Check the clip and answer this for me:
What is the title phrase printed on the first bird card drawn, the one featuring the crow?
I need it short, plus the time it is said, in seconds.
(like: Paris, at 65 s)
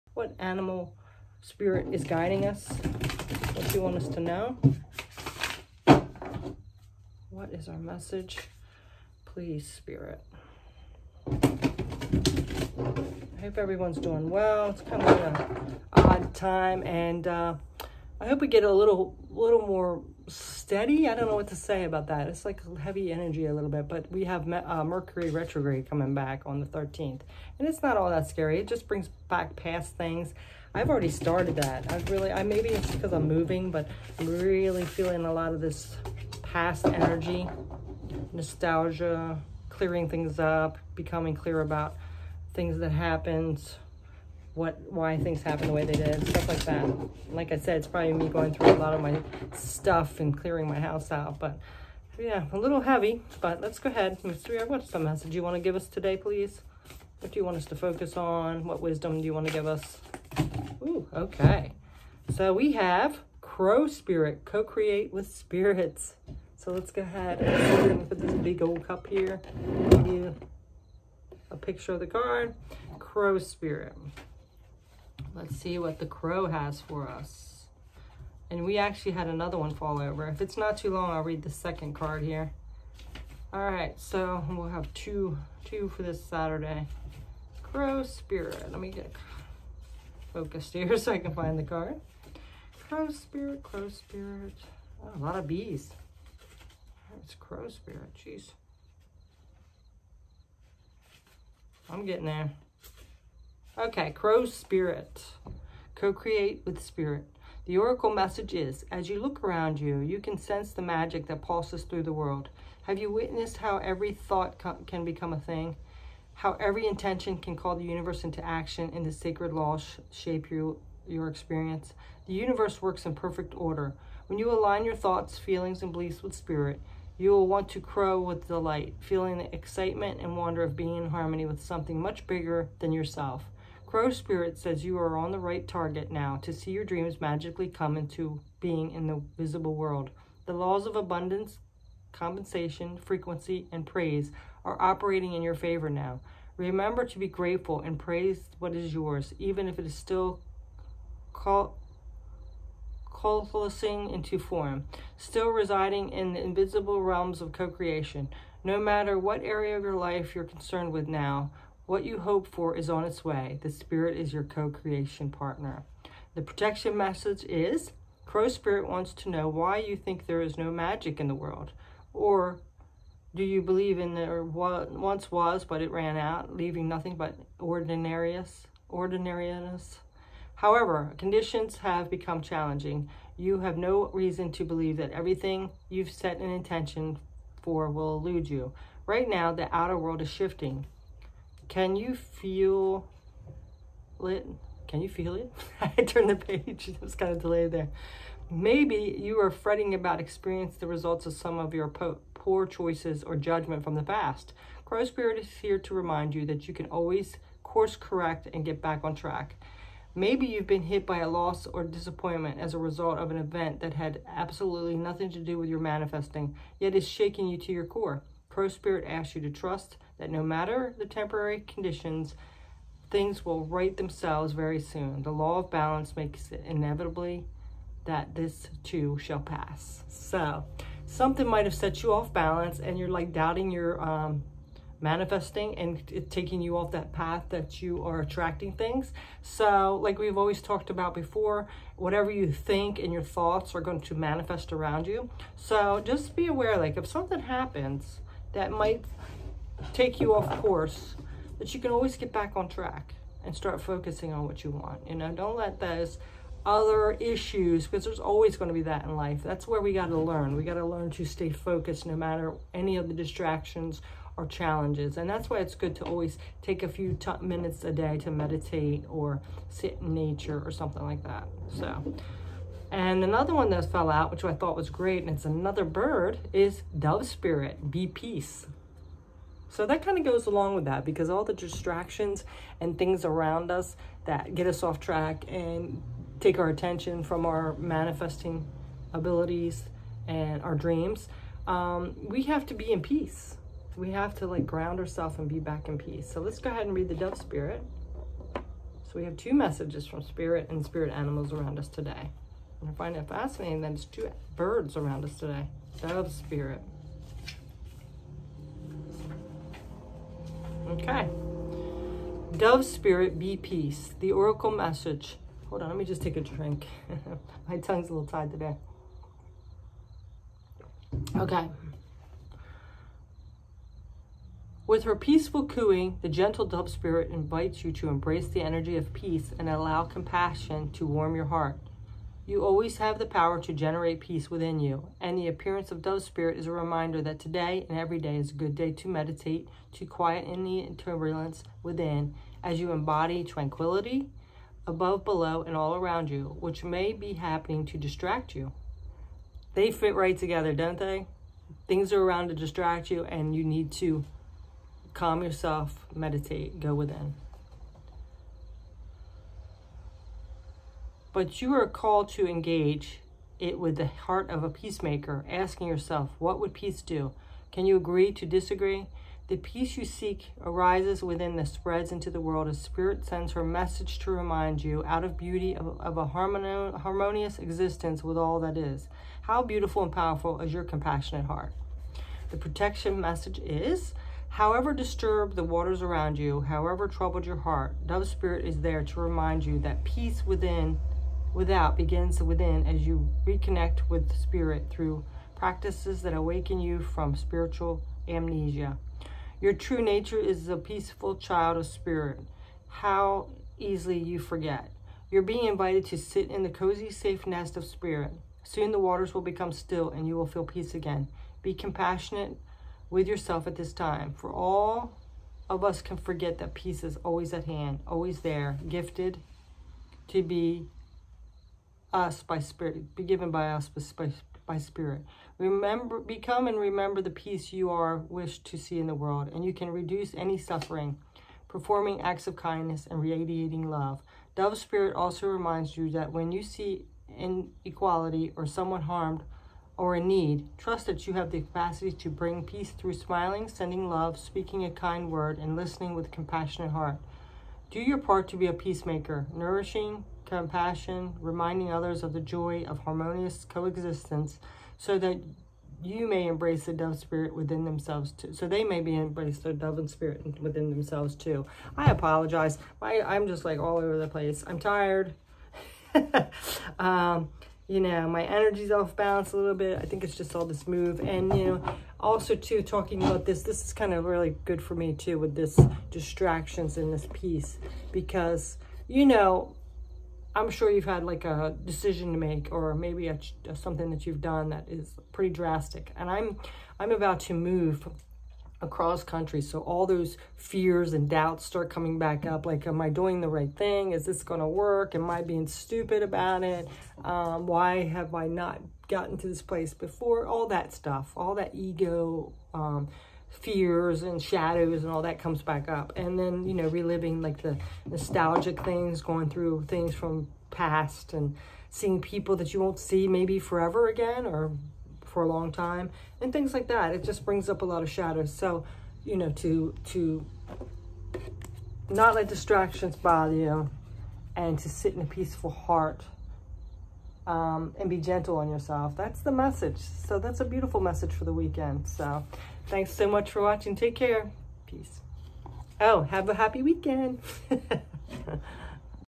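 Co-create with Spirit, at 64 s.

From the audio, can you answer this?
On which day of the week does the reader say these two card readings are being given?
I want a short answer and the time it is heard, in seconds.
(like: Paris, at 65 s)
Saturday, at 86 s.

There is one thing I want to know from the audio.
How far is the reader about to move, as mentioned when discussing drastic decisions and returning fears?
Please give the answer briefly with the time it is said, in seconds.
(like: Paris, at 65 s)
across country, at 488 s.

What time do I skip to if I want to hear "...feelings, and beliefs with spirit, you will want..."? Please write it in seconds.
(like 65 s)
125 s.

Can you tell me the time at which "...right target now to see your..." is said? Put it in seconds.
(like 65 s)
135 s.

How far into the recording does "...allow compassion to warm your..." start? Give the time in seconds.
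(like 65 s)
329 s.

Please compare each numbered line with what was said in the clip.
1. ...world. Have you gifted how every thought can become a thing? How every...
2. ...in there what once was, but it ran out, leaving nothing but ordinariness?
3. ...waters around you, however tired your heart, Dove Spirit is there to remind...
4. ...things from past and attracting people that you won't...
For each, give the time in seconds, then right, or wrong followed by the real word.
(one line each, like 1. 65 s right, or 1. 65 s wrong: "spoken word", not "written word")
1. 112 s wrong: "witnessed", not "gifted"
2. 173 s right
3. 385 s wrong: "troubled", not "tired"
4. 509 s wrong: "seeing", not "attracting".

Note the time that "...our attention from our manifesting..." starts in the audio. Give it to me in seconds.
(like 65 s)
286 s.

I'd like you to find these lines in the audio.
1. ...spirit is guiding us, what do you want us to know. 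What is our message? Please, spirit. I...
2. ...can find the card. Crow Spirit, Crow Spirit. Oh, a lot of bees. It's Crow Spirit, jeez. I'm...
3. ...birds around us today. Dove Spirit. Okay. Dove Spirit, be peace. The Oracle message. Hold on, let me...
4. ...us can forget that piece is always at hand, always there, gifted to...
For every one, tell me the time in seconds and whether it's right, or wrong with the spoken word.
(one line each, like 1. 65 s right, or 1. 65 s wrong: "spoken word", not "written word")
1. 1 s right
2. 91 s right
3. 304 s right
4. 415 s wrong: "peace", not "piece".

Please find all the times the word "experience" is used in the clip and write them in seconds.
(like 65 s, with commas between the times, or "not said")
121 s, 200 s.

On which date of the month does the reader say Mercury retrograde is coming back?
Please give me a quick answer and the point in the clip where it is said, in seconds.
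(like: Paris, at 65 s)
13th, at 26 s.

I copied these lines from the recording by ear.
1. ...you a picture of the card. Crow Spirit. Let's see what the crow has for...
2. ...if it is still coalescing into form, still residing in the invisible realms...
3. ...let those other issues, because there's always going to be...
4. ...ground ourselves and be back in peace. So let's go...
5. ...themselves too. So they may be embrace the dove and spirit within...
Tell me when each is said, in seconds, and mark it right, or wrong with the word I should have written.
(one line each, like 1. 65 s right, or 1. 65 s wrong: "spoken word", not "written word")
1. 70 s right
2. 149 s right
3. 255 s right
4. 294 s right
5. 457 s right.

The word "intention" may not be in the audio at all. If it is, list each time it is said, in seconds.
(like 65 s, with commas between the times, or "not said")
116 s, 186 s.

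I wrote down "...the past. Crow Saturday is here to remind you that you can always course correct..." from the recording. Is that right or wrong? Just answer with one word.
wrong.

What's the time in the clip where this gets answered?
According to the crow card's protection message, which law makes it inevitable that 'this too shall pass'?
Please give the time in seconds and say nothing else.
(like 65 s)
225 s.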